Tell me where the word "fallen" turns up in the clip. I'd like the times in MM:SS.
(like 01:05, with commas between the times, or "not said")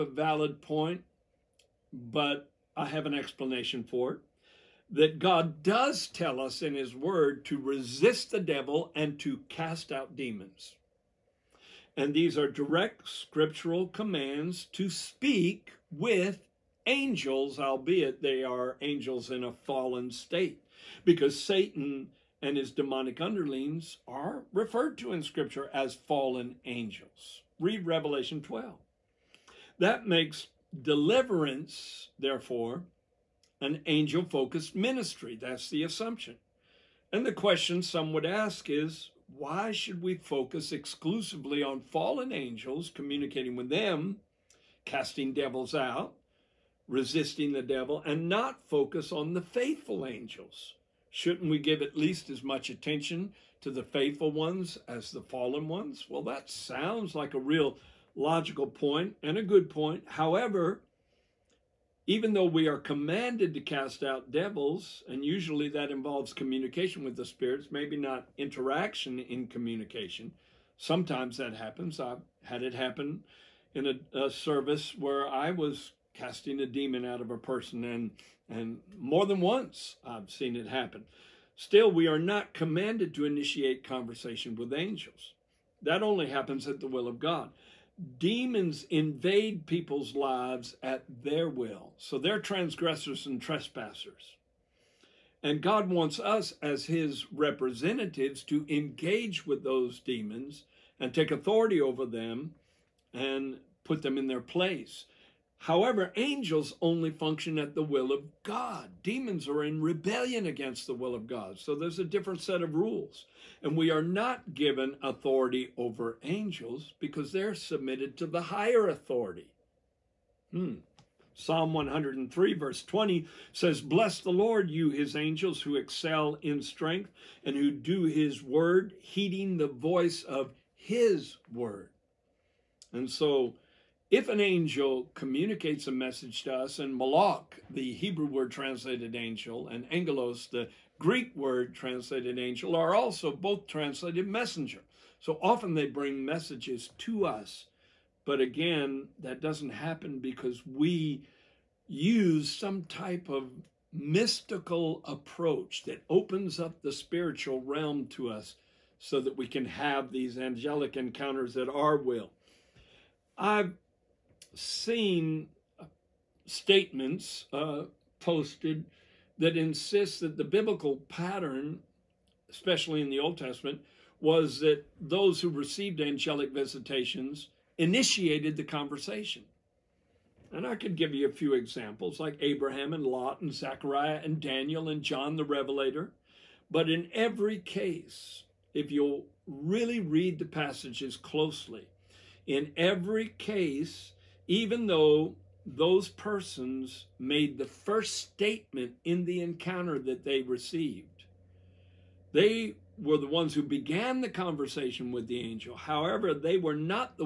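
00:19, 00:25, 00:41, 00:55.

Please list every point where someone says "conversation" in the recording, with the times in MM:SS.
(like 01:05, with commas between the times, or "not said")
01:23, 02:58, 03:24.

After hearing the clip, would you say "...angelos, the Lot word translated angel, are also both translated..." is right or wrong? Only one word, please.
wrong.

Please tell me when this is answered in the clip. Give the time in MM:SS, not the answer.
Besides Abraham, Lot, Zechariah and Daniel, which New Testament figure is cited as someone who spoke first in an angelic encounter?
03:05.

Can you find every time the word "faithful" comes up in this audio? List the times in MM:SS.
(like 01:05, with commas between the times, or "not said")
00:49, 00:53.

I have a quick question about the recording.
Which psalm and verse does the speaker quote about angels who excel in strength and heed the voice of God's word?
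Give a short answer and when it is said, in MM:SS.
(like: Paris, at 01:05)
Psalm 103, verse 20, at 02:01.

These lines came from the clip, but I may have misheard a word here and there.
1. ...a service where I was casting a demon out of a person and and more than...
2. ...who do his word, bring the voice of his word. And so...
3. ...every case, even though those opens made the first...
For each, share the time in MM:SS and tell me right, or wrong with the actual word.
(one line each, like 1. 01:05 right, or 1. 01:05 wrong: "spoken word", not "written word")
1. 01:14 right
2. 02:07 wrong: "heeding", not "bring"
3. 03:12 wrong: "persons", not "opens".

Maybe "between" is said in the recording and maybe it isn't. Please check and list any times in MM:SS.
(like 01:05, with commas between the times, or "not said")
not said.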